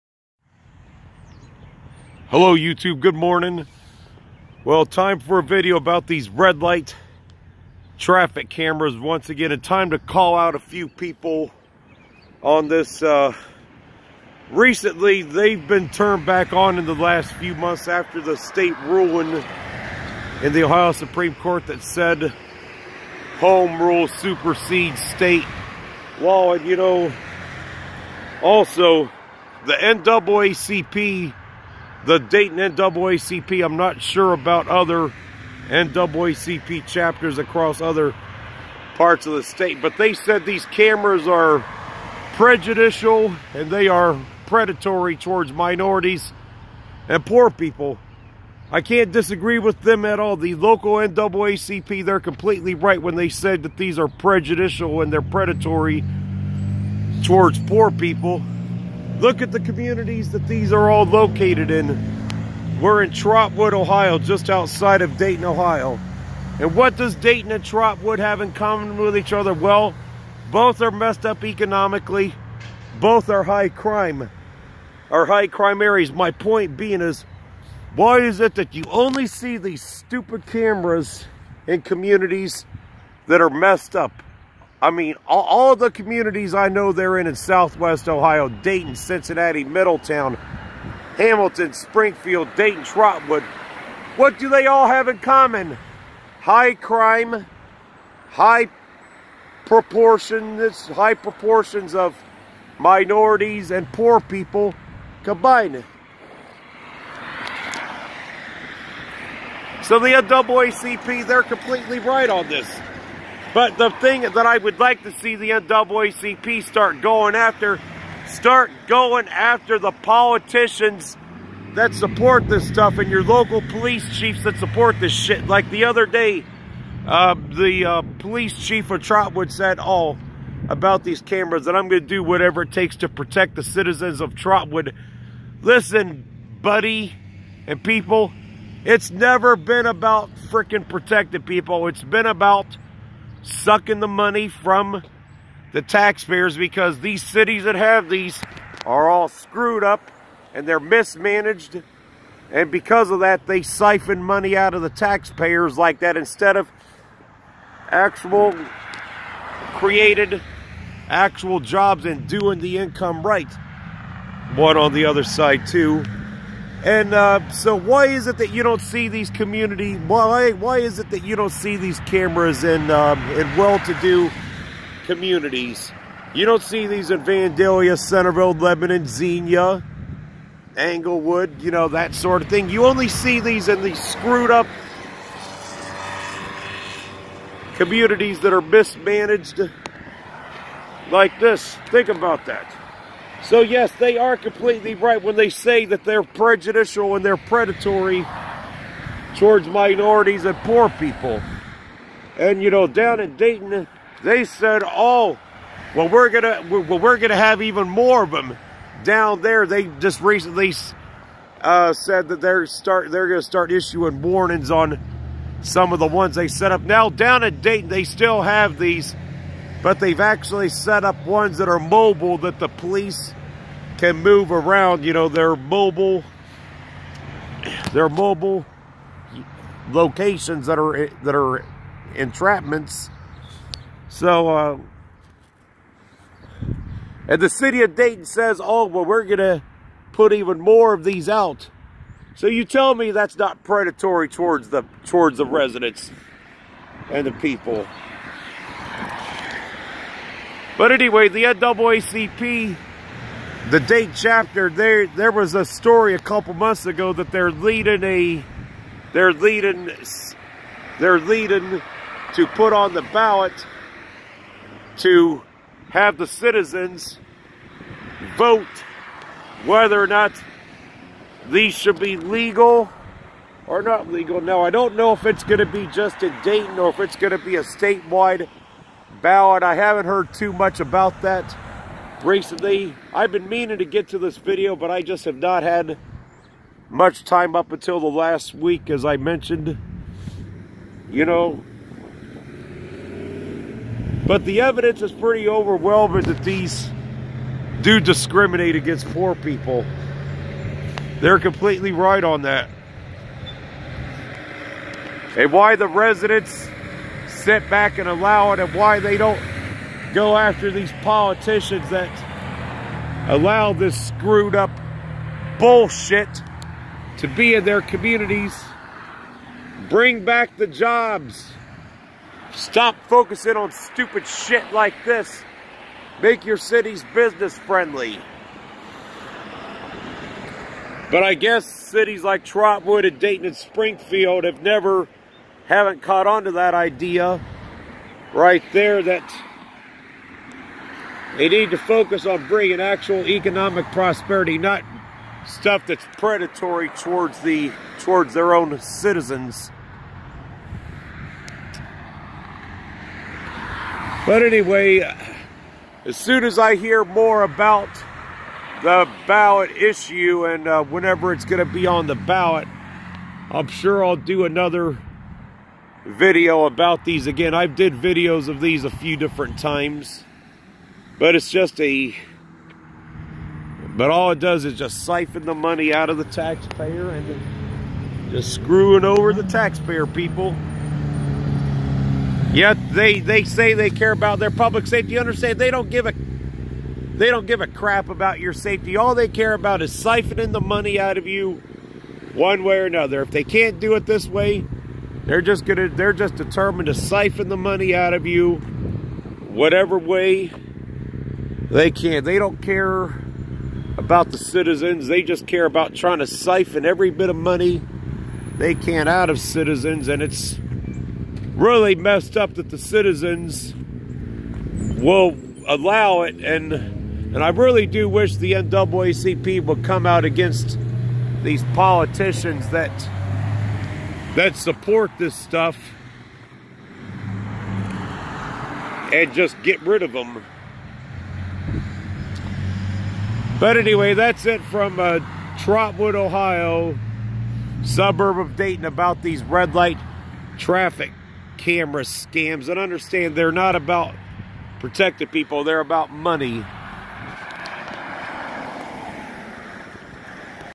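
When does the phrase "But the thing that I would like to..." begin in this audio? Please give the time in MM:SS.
01:53.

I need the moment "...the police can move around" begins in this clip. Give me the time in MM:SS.
03:42.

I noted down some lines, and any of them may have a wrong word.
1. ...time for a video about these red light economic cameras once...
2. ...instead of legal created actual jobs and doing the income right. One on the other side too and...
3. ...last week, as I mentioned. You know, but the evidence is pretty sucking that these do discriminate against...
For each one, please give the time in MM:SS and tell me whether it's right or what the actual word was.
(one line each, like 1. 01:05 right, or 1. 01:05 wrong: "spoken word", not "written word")
1. 00:04 wrong: "traffic", not "economic"
2. 02:36 wrong: "actual", not "legal"
3. 04:48 wrong: "overwhelming", not "sucking".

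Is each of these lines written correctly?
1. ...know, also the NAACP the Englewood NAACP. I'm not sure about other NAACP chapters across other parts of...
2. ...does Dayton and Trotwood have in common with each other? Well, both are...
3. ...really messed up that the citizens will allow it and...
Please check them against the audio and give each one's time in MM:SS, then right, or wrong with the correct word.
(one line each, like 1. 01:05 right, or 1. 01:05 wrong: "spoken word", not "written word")
1. 00:26 wrong: "Dayton", not "Englewood"
2. 01:06 right
3. 06:51 right.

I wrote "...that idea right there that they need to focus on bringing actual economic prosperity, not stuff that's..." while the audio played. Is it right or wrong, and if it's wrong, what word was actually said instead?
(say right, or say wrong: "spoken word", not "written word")
right.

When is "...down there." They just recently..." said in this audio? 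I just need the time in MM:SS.
03:29.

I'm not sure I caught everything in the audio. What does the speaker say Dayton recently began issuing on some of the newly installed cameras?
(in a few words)
warnings.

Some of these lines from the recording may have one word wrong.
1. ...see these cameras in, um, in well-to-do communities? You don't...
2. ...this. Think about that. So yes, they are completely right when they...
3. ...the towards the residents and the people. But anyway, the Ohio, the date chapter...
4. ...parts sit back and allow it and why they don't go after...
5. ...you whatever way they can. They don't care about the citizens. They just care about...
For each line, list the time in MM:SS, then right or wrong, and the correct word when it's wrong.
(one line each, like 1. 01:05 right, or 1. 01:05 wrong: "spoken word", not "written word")
1. 02:51 right
2. 03:11 right
3. 04:04 wrong: "NAACP", not "Ohio"
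4. 05:05 wrong: "residents", not "parts"
5. 06:38 right.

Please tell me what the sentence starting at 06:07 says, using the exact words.
I've did videos of these a few different times.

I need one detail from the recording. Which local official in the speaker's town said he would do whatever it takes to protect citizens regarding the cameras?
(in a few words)
police chief.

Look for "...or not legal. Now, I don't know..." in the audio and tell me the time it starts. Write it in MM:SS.
04:33.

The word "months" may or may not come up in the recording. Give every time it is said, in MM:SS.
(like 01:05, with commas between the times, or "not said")
00:17, 04:16.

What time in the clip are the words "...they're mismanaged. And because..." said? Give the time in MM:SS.
02:30.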